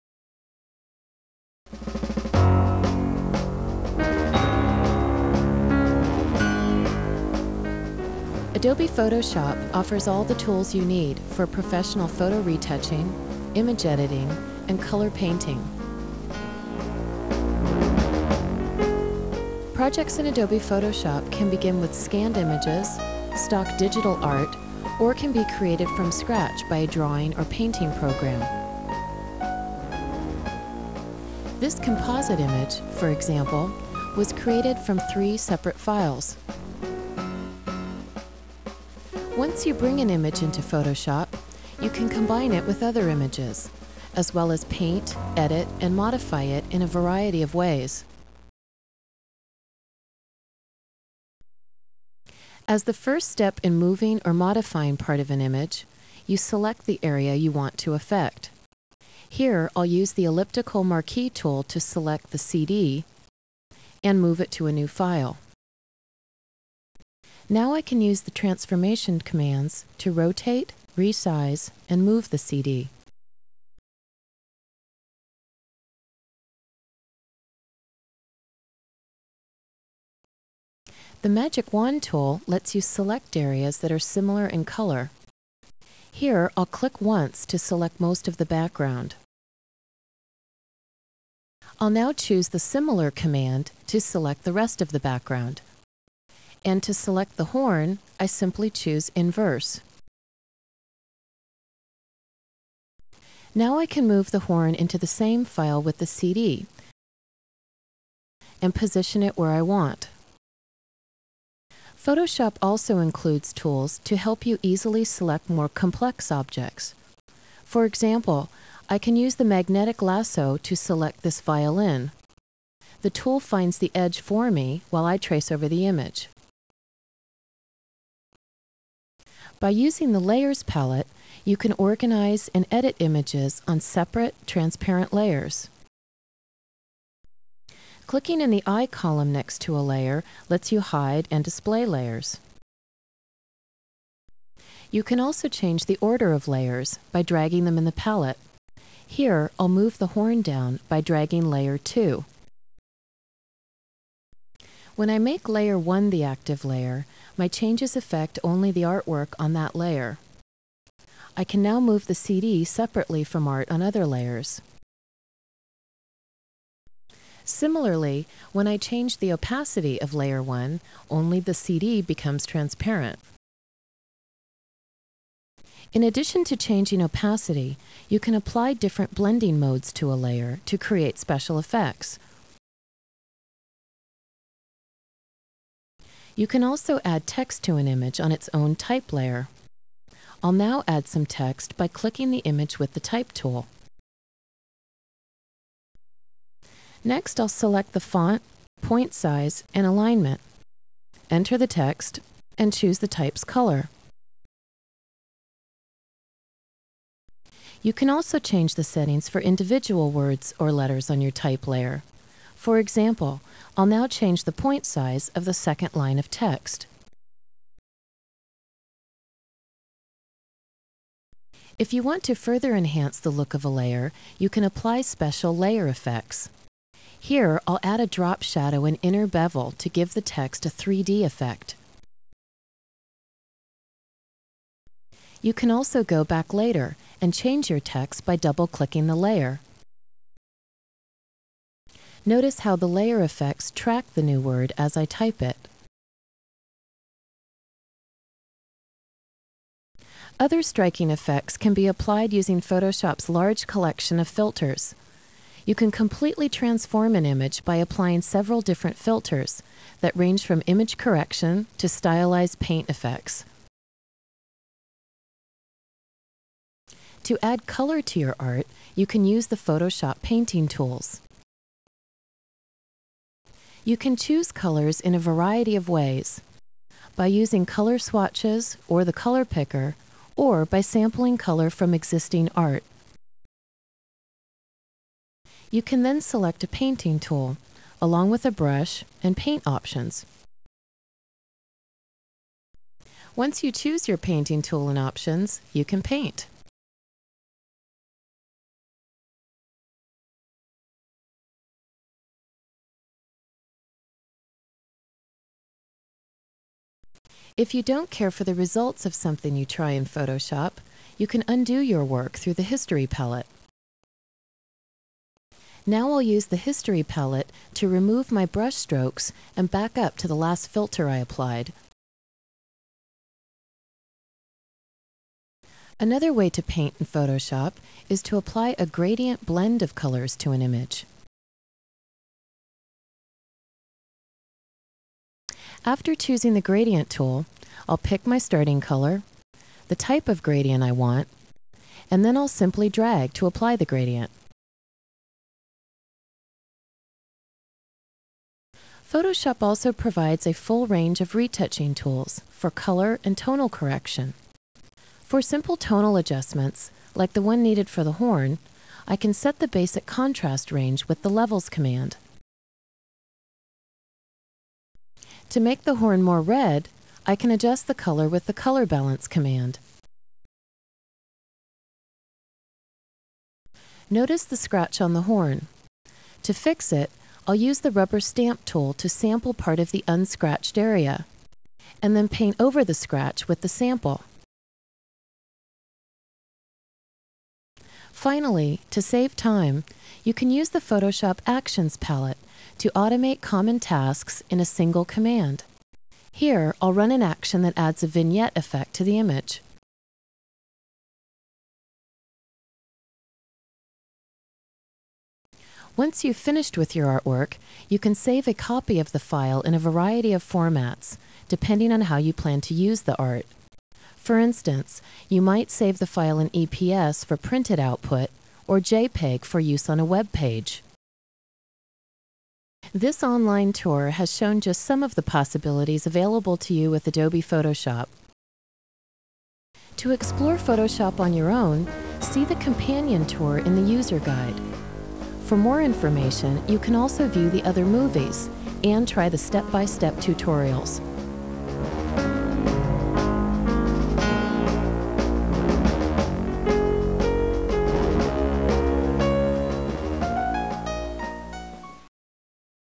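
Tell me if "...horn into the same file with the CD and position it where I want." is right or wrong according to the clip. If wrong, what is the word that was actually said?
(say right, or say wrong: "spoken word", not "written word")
right.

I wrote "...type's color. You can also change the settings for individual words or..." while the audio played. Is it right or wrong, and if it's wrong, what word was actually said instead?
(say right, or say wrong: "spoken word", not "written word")
right.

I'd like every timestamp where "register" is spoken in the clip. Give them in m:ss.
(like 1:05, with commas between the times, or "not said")
not said.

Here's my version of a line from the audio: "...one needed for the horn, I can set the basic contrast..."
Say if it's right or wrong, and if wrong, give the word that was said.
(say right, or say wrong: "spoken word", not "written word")
right.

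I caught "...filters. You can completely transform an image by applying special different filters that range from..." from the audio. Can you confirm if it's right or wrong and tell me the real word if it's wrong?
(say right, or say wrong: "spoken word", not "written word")
wrong: "several", not "special".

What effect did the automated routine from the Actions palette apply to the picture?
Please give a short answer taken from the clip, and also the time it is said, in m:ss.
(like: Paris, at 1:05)
vignette, at 6:38.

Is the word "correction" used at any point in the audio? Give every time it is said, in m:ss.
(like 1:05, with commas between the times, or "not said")
4:20, 5:53.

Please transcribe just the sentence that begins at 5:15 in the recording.
Now I'll use the History palette to remove my brush strokes and back up to the last filter I applied.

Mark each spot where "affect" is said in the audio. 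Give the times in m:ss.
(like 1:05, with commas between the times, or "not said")
0:57, 2:37.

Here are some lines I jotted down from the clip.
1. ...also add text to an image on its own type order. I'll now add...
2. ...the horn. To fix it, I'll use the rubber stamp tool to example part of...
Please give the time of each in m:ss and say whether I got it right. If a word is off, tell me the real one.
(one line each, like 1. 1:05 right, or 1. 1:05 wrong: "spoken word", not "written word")
1. 3:06 wrong: "layer", not "order"
2. 6:15 wrong: "sample", not "example".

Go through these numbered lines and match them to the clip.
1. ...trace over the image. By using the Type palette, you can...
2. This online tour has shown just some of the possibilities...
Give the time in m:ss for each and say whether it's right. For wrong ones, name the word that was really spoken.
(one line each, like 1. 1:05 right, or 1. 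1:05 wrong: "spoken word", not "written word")
1. 2:05 wrong: "Layers", not "Type"
2. 7:02 right.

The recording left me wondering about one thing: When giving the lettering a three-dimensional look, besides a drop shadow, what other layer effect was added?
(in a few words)
inner bevel.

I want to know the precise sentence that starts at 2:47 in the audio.
Similarly, when I change the opacity of Layer 1, only the CD becomes transparent.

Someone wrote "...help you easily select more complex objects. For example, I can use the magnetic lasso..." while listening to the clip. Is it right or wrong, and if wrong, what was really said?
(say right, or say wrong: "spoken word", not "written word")
right.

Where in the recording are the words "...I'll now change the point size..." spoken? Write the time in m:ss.
3:33.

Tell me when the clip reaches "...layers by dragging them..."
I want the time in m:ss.
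2:26.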